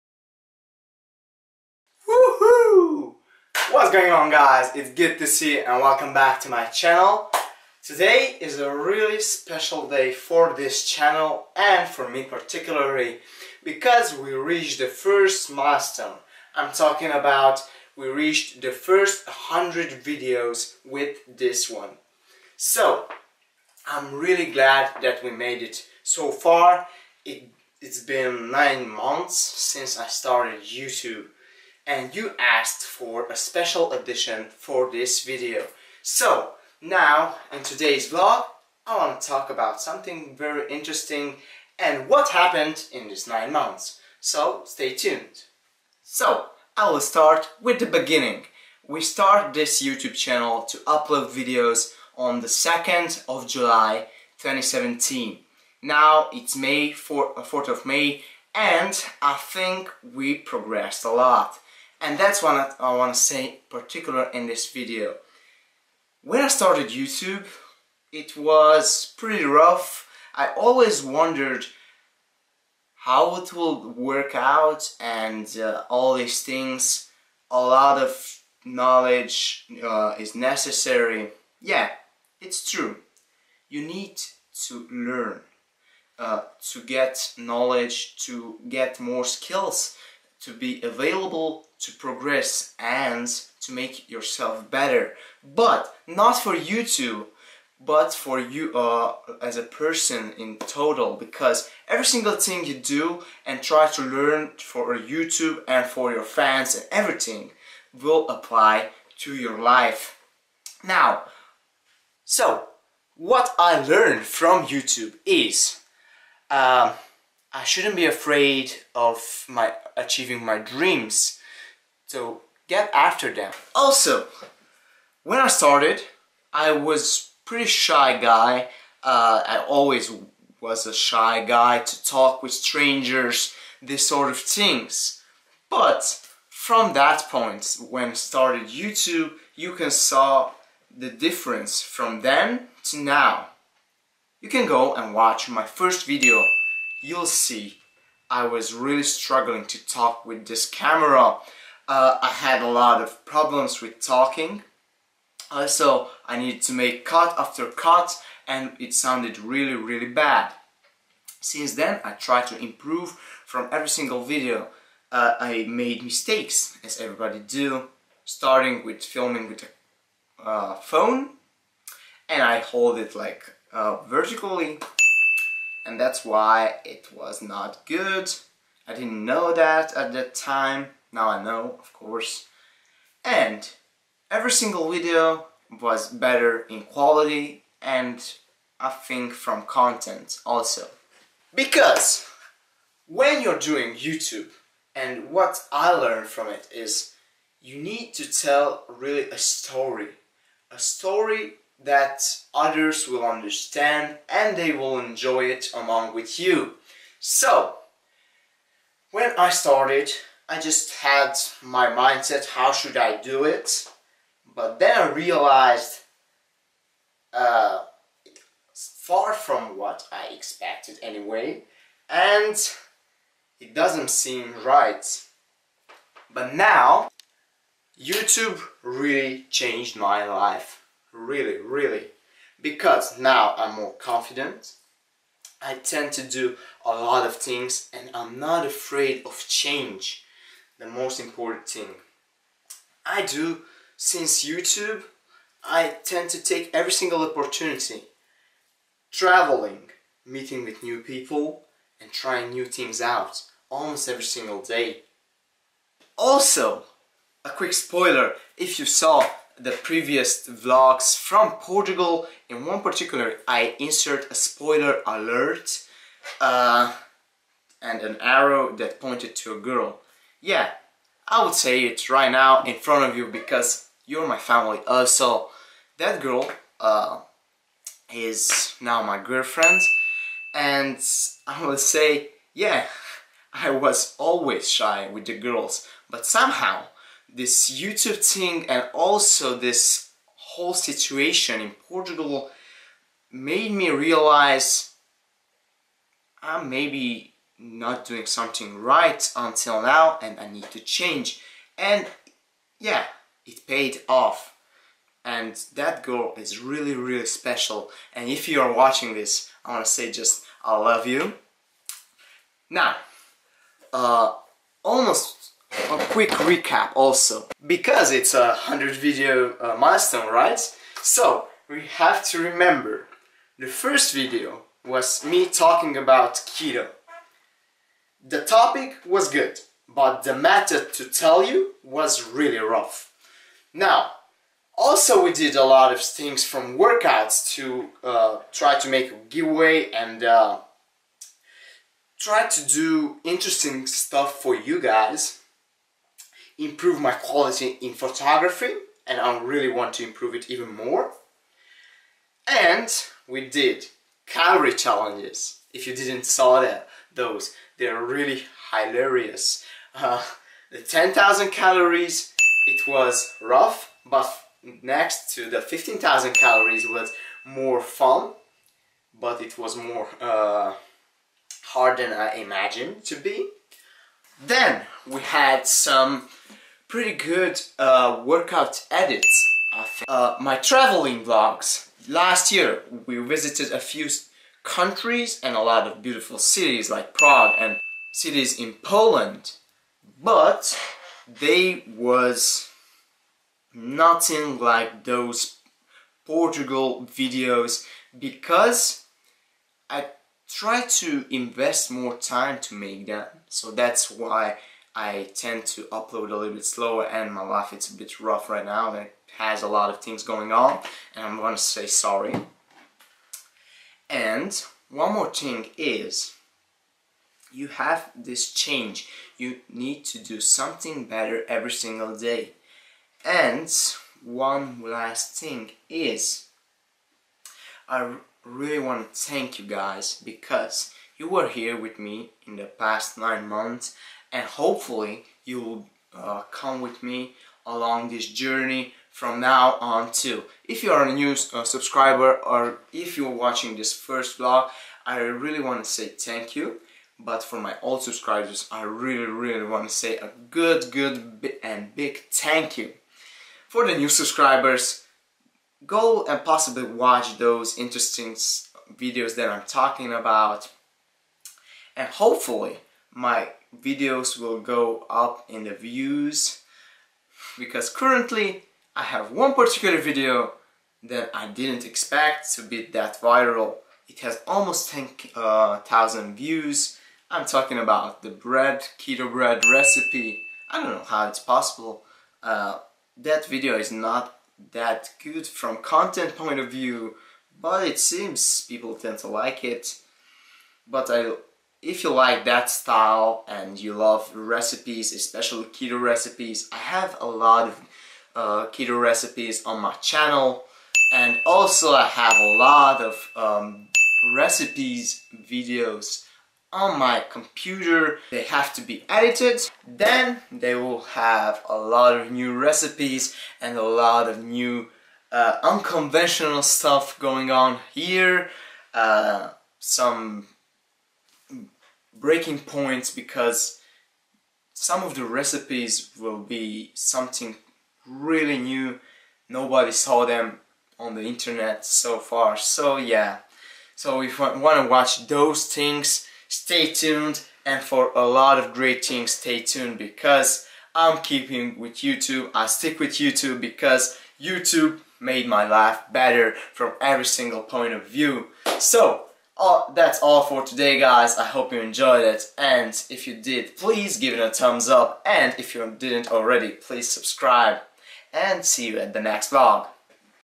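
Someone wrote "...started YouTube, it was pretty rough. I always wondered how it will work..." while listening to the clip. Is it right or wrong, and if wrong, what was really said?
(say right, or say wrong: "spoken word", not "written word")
right.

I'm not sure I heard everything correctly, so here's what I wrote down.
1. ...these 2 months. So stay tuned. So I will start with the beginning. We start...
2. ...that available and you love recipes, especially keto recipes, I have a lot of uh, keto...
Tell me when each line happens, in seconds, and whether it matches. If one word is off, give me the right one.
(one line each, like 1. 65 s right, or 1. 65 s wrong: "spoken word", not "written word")
1. 43 s wrong: "9", not "2"
2. 492 s wrong: "style", not "available".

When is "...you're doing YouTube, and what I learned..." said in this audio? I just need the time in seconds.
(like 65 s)
193 s.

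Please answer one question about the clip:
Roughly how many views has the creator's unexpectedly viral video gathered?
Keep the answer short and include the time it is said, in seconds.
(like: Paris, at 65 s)
almost 10,000, at 474 s.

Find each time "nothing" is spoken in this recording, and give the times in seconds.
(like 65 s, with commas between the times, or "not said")
393 s.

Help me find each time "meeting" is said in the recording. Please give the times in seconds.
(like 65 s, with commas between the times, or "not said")
250 s.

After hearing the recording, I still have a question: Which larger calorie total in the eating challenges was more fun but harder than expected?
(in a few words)
15,000 calories.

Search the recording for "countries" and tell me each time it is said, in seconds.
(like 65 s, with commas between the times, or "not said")
384 s.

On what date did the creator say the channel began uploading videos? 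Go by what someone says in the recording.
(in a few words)
2nd of July 2017.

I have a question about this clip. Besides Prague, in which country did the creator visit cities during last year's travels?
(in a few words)
Poland.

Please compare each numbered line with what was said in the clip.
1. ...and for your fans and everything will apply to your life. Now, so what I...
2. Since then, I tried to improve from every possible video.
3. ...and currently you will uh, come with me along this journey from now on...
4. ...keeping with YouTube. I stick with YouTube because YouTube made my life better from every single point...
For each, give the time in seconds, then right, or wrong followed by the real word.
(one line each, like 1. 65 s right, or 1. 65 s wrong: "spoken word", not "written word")
1. 105 s right
2. 161 s wrong: "single", not "possible"
3. 434 s wrong: "hopefully", not "currently"
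4. 541 s right.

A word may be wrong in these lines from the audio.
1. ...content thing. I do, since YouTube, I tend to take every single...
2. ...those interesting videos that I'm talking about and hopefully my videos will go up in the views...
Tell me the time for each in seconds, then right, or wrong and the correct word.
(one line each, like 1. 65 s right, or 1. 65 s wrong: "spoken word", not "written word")
1. 241 s wrong: "important", not "content"
2. 457 s right.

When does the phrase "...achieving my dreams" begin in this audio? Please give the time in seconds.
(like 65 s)
119 s.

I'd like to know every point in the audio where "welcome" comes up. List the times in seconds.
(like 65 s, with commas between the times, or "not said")
5 s.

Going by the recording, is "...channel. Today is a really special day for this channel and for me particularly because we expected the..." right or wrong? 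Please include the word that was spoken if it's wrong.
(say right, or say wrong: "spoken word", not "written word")
wrong: "reached", not "expected".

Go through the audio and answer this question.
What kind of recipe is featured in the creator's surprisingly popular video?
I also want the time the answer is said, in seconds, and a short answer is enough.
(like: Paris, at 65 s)
keto bread, at 478 s.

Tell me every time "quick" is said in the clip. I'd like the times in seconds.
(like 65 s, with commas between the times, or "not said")
257 s, 316 s.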